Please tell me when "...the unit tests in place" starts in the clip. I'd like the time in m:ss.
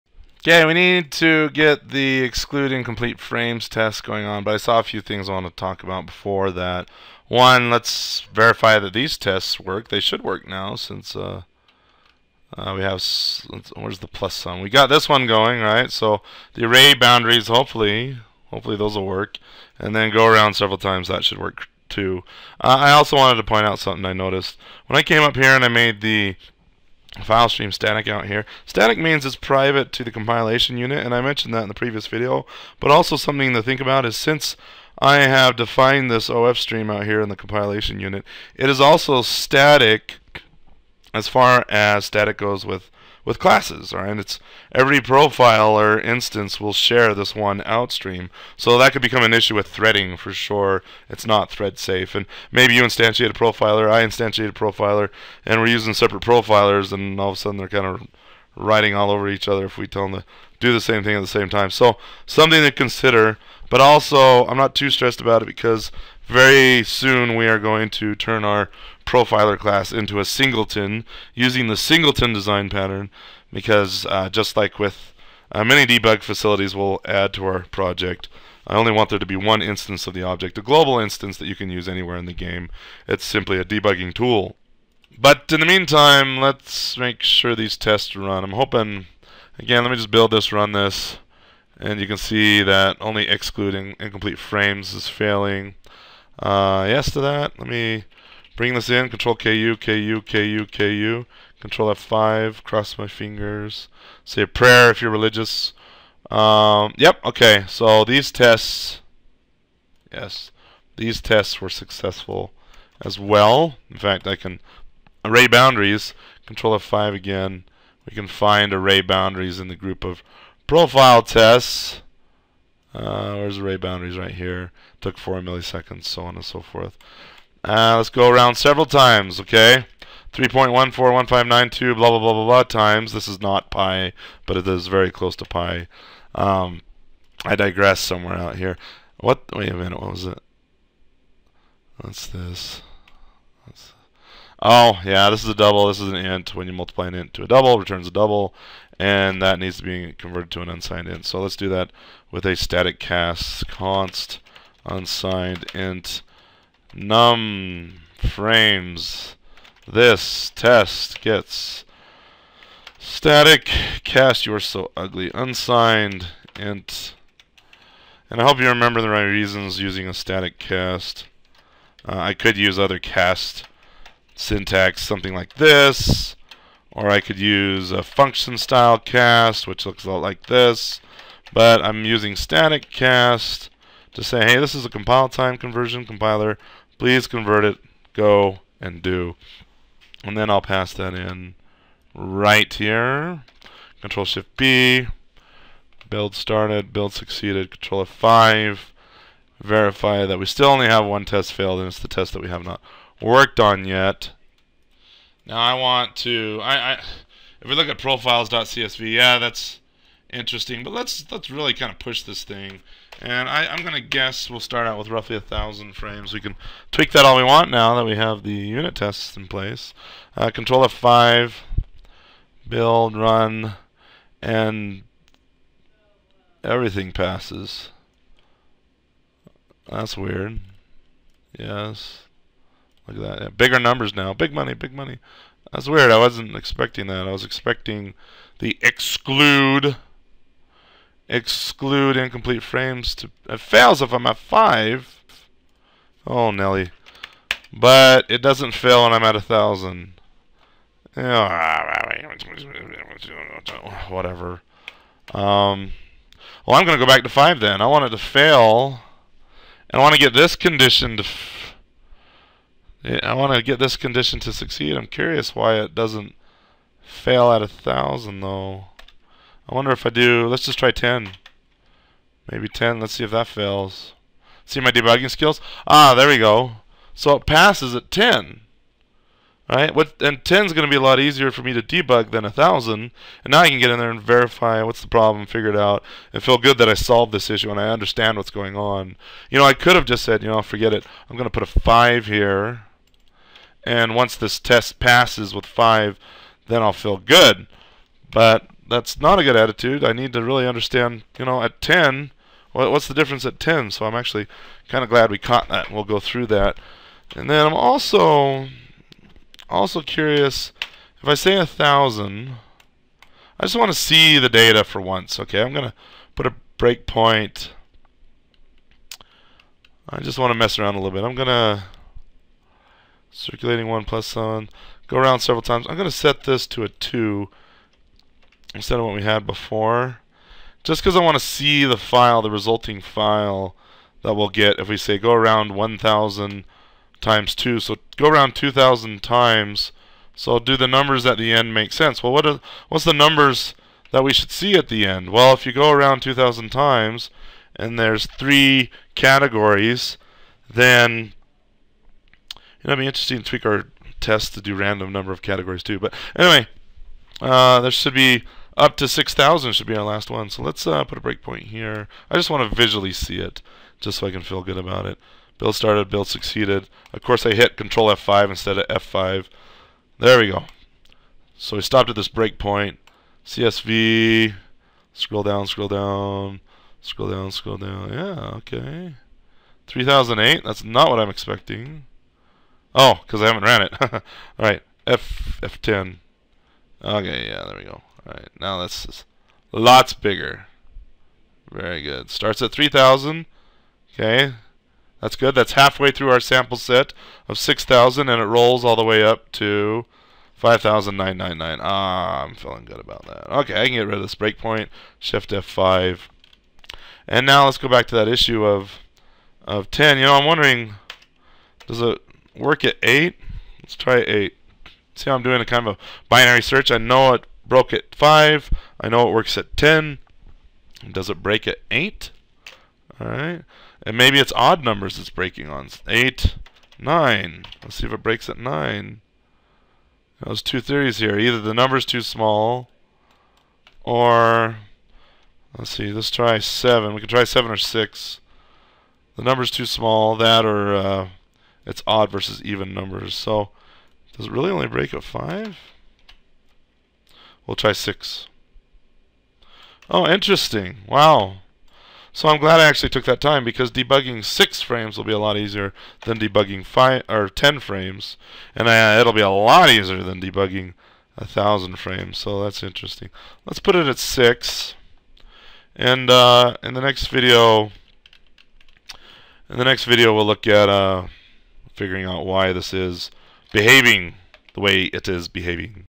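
3:38.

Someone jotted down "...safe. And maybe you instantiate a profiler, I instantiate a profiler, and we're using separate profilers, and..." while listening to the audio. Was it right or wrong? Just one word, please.
right.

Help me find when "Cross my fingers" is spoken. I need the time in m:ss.
1:42.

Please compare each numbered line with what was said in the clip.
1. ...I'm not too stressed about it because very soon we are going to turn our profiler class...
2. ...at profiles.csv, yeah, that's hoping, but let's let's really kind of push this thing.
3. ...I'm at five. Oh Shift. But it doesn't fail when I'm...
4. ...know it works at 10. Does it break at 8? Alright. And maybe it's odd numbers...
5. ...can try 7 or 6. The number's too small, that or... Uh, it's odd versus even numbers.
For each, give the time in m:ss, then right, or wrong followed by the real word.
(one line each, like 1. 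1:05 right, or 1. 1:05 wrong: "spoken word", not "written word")
1. 1:04 right
2. 3:27 wrong: "interesting", not "hoping"
3. 4:04 wrong: "Nelly", not "Shift"
4. 6:59 right
5. 7:17 right.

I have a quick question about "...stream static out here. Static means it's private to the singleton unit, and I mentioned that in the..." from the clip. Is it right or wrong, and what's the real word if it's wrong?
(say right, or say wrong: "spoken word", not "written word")
wrong: "compilation", not "singleton".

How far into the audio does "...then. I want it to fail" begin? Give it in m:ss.
4:17.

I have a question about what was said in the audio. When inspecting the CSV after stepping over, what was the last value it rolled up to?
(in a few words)
5999.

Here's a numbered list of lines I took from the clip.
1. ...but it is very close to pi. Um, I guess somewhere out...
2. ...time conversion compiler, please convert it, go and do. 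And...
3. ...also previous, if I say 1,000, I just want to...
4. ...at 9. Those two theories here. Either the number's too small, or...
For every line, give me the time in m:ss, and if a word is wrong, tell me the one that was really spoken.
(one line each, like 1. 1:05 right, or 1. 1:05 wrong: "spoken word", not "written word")
1. 2:14 wrong: "digress", not "guess"
2. 3:05 right
3. 5:09 wrong: "curious", not "previous"
4. 7:08 right.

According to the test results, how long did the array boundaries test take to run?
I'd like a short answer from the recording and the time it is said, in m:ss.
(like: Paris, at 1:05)
4 milliseconds, at 2:05.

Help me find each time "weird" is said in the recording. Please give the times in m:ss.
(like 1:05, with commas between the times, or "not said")
3:50, 3:55.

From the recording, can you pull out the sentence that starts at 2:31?
So let's do that with a static cast const unsigned int num frames.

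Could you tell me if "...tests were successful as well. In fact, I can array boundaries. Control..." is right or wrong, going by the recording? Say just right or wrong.
right.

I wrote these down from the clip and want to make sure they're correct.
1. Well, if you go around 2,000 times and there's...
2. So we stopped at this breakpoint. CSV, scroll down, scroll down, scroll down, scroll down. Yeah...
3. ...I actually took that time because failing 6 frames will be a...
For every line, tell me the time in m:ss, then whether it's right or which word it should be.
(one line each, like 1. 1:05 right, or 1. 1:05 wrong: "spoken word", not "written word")
1. 5:45 right
2. 6:11 right
3. 7:32 wrong: "debugging", not "failing".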